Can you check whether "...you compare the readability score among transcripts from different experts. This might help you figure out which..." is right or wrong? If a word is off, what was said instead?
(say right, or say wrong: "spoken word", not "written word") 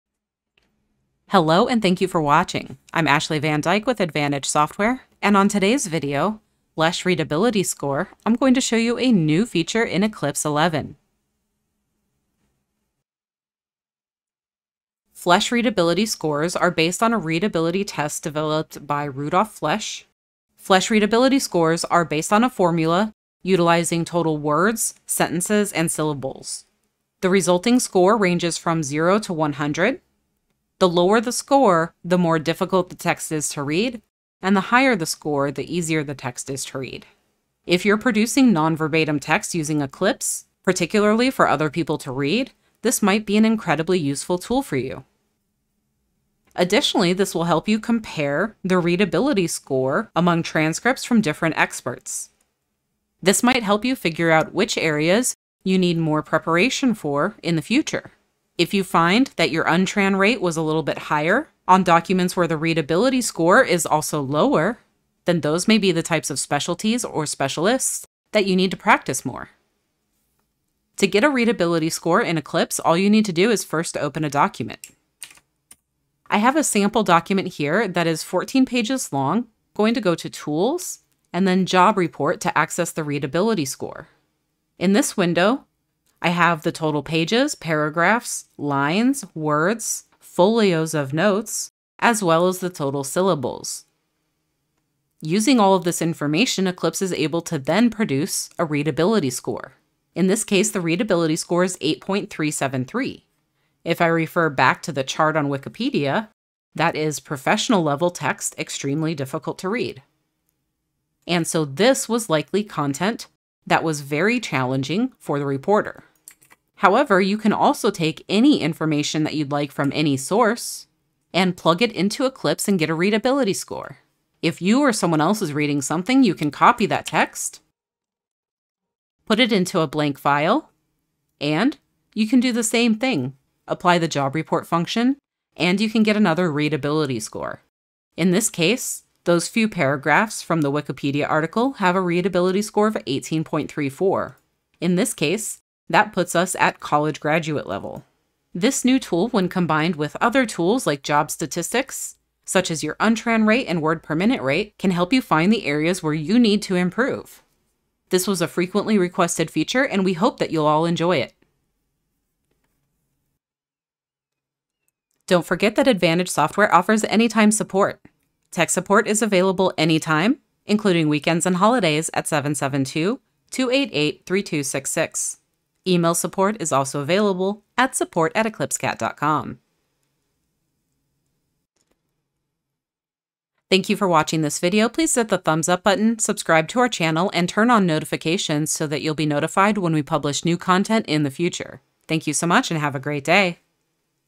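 right.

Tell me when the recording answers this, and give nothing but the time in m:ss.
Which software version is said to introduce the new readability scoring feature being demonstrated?
0:10.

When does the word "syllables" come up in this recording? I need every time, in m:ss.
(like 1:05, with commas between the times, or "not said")
0:25, 1:33.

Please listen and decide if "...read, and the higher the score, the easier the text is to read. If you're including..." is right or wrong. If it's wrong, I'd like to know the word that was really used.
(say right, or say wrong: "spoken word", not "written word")
wrong: "producing", not "including".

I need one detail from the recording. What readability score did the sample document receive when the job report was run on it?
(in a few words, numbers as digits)
8.373.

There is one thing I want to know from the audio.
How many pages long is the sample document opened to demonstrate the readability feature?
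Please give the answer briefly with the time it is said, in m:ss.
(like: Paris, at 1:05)
14, at 1:18.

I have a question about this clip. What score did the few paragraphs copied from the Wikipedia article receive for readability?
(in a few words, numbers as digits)
18.34.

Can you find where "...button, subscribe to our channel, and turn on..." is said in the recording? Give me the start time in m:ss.
3:05.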